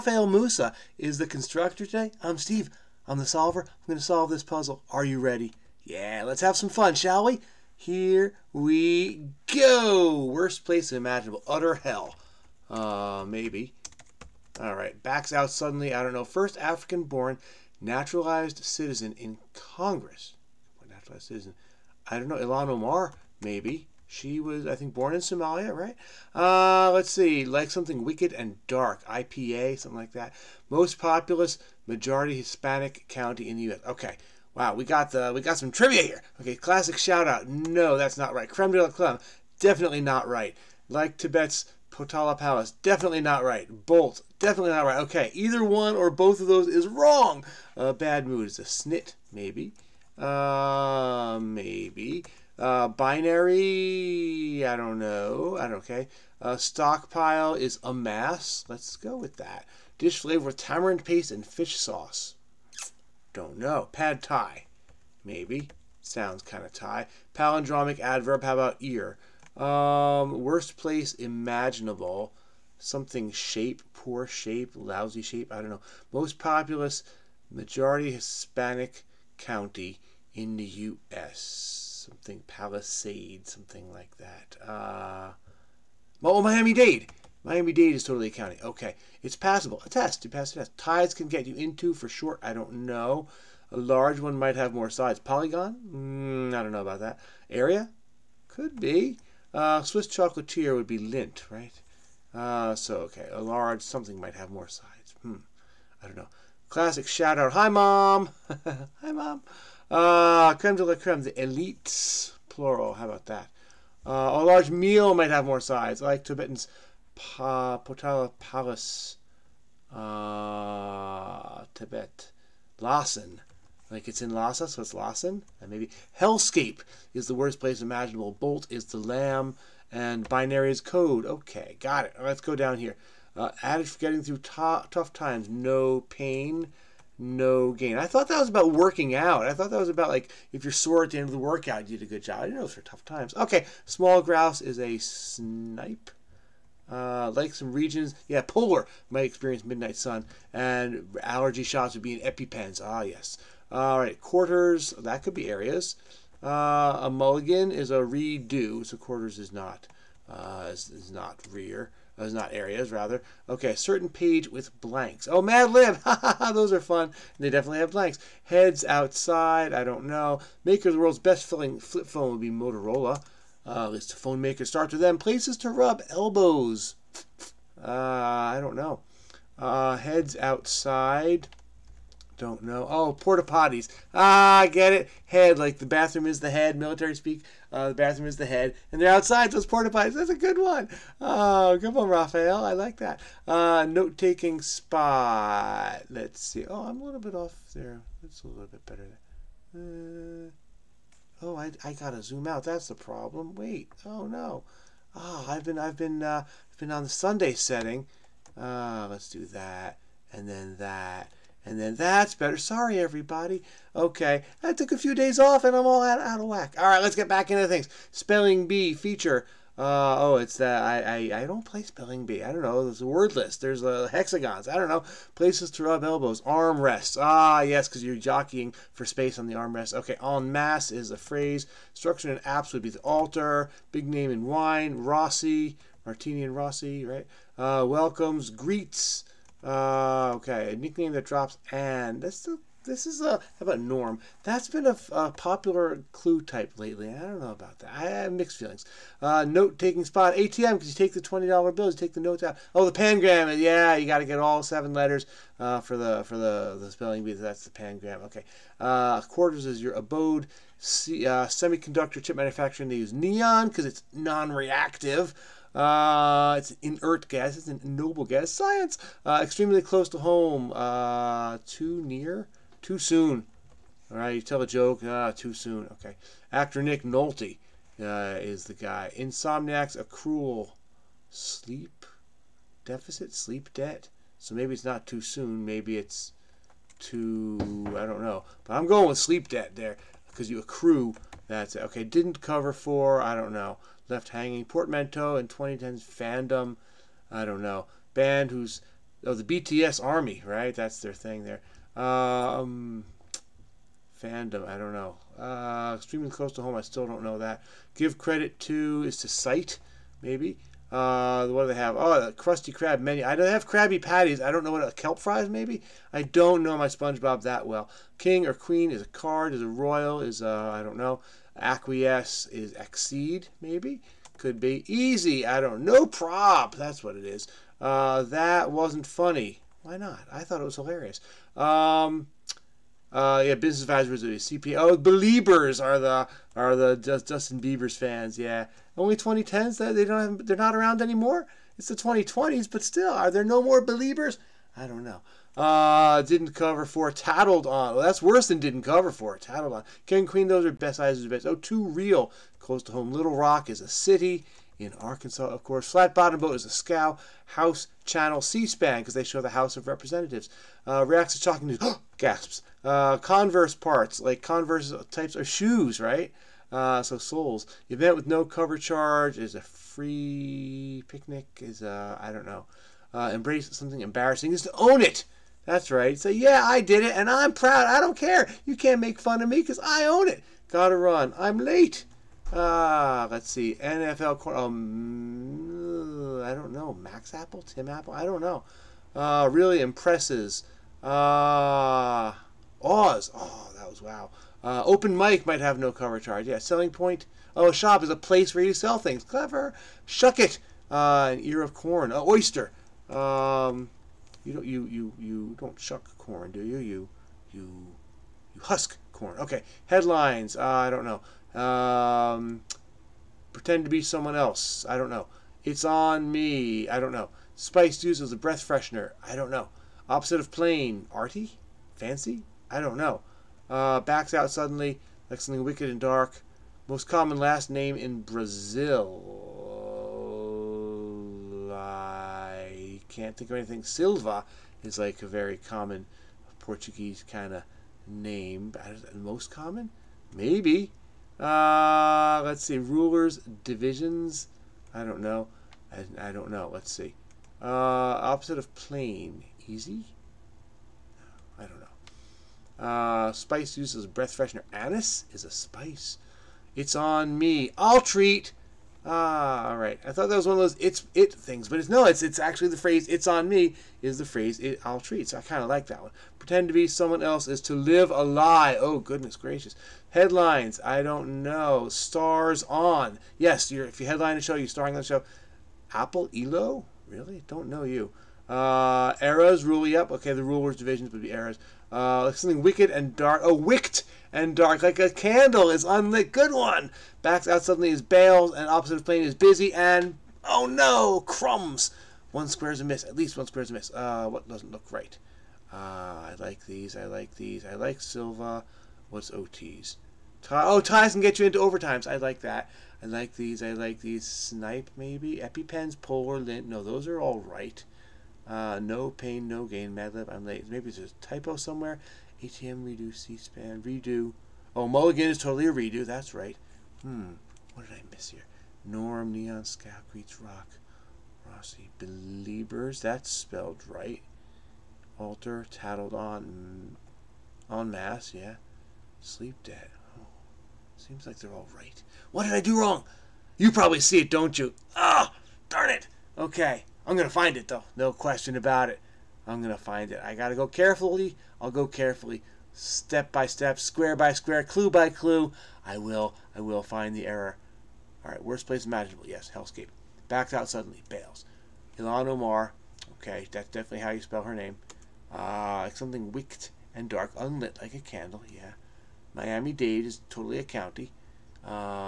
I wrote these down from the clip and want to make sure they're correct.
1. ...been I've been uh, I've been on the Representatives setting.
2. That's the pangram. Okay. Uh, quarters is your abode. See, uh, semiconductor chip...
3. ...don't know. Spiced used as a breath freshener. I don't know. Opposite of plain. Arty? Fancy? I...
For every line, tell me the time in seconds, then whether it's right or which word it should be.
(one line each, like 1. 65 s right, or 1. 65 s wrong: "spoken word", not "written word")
1. 205 s wrong: "Sunday", not "Representatives"
2. 257 s right
3. 416 s right.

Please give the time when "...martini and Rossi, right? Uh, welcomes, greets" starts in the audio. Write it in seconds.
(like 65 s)
236 s.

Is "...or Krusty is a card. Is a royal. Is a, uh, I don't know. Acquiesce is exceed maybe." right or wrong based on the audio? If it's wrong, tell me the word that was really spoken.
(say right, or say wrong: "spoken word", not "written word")
wrong: "Queen", not "Krusty".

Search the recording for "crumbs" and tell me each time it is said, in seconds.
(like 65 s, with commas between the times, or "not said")
491 s.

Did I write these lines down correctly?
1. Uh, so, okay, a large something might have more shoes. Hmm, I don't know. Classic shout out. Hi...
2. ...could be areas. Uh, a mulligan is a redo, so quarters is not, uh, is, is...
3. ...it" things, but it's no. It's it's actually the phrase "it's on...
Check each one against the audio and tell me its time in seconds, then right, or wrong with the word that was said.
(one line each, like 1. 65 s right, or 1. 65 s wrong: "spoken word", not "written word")
1. 102 s wrong: "sides", not "shoes"
2. 155 s right
3. 461 s right.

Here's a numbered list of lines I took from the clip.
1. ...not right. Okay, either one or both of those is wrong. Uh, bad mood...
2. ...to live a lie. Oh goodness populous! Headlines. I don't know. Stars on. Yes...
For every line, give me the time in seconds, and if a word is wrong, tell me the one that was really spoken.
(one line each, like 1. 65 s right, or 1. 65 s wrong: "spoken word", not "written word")
1. 44 s right
2. 467 s wrong: "gracious", not "populous".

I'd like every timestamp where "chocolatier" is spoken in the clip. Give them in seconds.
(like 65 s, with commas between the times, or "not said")
100 s.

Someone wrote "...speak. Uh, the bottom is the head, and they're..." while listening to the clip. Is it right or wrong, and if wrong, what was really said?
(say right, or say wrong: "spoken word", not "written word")
wrong: "bathroom", not "bottom".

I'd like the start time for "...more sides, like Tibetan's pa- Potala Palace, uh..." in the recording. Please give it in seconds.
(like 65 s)
115 s.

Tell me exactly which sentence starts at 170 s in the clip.
Maker of the world's best filling flip phone would be Motorola.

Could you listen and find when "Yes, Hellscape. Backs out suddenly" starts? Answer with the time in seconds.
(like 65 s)
549 s.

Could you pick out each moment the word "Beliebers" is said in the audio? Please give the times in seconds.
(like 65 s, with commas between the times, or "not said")
334 s, 343 s, 522 s.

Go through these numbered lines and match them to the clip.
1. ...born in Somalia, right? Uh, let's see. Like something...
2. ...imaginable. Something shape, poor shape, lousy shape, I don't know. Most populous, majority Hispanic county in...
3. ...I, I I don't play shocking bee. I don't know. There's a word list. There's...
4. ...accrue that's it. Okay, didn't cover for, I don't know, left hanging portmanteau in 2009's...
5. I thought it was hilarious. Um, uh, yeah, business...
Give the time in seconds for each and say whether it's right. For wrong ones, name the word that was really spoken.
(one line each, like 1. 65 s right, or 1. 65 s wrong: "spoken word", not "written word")
1. 24 s right
2. 71 s right
3. 220 s wrong: "spelling", not "shocking"
4. 290 s wrong: "2010", not "2009"
5. 330 s right.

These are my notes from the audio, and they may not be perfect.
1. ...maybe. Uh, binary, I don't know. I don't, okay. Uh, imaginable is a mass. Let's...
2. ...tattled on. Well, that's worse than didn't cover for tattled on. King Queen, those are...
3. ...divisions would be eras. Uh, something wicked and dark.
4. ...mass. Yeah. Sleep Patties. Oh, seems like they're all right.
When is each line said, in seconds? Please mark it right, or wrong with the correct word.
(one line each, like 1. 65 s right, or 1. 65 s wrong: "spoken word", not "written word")
1. 51 s wrong: "stockpile", not "imaginable"
2. 347 s right
3. 480 s right
4. 527 s wrong: "Dead", not "Patties".